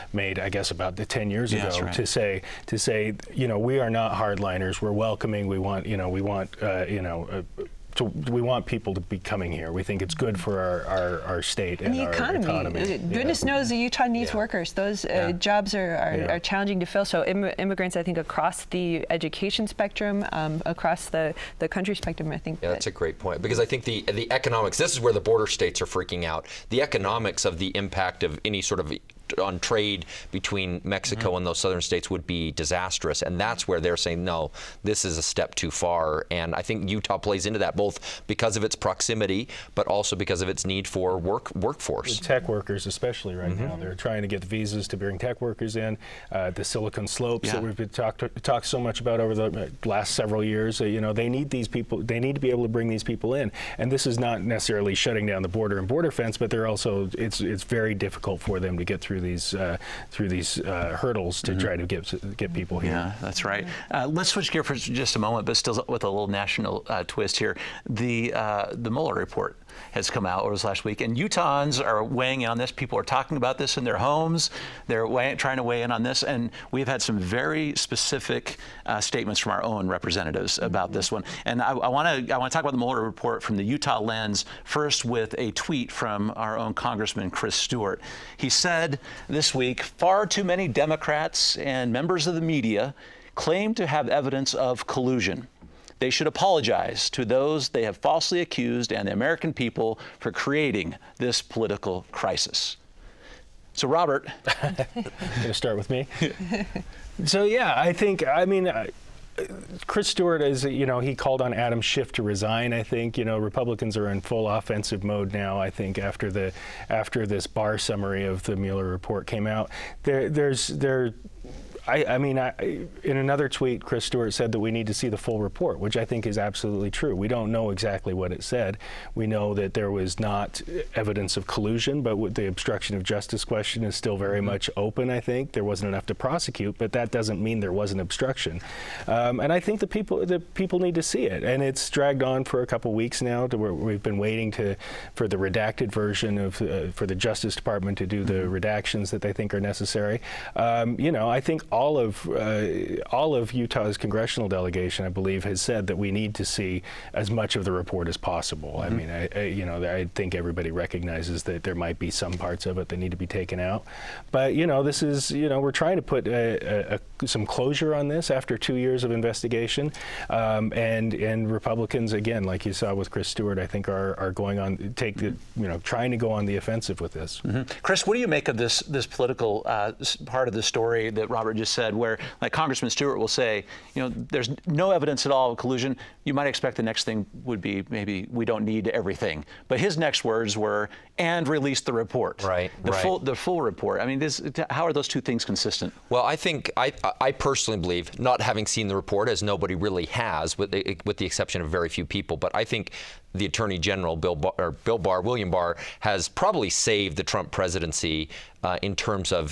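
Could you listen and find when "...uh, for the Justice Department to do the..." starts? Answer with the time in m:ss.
2:26.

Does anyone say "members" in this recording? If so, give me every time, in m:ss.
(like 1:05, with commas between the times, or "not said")
1:31.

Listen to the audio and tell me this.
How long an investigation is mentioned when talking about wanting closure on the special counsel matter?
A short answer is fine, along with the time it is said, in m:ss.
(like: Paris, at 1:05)
2 years, at 2:48.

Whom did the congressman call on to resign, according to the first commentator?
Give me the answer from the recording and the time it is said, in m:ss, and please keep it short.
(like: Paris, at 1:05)
Adam Schiff, at 1:51.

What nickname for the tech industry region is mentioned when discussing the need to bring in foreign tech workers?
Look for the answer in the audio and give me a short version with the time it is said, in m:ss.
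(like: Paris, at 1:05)
Silicon Slopes, at 0:46.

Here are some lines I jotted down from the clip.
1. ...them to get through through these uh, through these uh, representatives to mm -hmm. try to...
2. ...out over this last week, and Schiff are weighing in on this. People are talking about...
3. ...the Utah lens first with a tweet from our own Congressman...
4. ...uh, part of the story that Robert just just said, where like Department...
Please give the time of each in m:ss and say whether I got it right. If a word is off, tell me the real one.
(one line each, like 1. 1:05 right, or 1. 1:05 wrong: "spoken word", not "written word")
1. 0:58 wrong: "hurdles", not "representatives"
2. 1:10 wrong: "Utahns", not "Schiff"
3. 1:23 right
4. 2:59 wrong: "Congressman", not "Department".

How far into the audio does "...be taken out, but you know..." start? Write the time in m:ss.
2:43.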